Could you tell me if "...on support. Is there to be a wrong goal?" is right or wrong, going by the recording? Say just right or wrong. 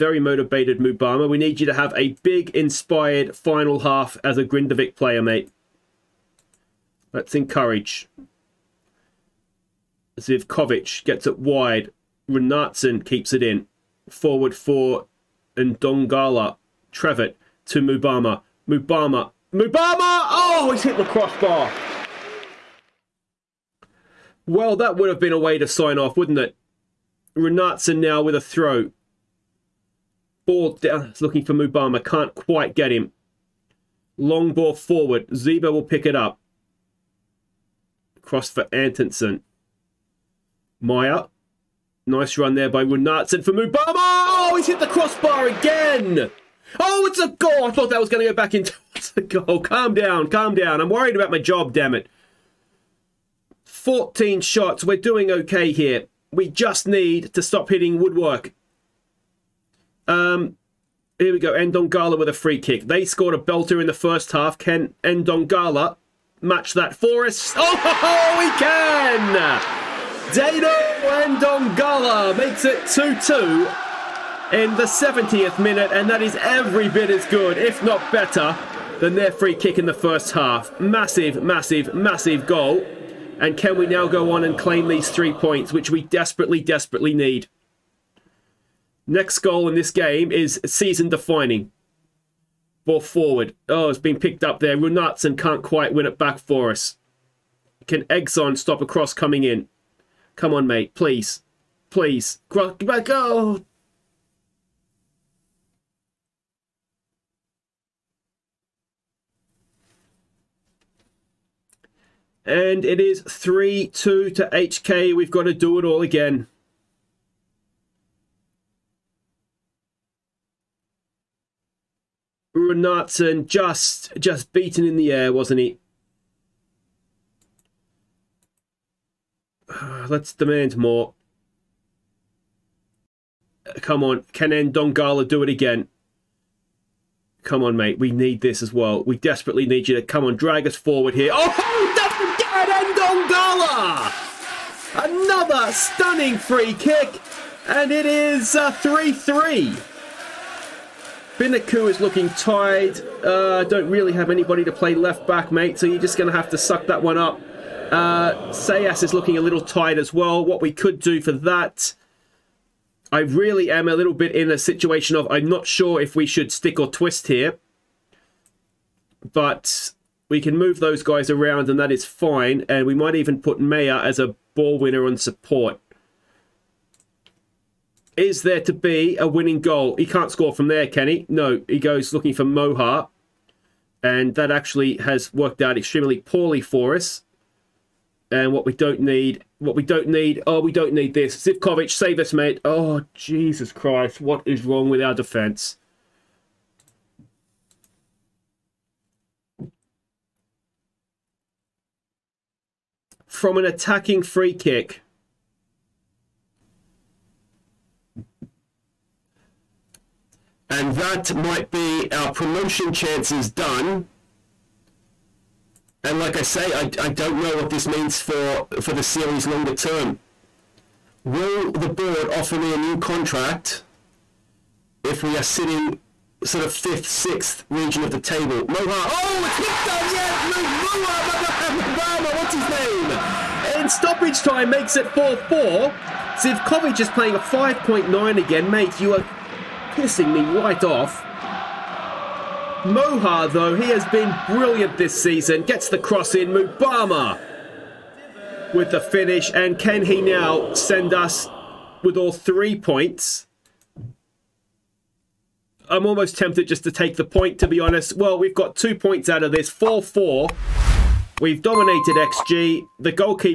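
wrong.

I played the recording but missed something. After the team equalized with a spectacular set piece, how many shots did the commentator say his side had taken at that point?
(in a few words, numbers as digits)
14.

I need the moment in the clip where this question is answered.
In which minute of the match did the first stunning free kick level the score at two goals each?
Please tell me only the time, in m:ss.
1:14.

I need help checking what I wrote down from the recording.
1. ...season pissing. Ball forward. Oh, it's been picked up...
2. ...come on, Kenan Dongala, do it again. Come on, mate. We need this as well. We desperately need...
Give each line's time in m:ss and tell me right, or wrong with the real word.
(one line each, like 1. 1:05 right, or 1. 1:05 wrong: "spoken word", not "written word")
1. 1:30 wrong: "defining", not "pissing"
2. 2:13 right.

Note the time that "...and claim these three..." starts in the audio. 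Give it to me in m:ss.
1:24.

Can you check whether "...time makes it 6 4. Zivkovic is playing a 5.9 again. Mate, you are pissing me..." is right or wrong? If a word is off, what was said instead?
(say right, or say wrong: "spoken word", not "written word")
wrong: "4", not "6".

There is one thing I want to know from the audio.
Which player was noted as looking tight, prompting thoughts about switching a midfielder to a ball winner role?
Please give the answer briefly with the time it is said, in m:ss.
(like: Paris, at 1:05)
Sayas, at 2:38.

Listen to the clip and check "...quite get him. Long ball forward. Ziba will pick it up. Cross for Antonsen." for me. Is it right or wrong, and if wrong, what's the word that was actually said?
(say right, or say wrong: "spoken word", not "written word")
right.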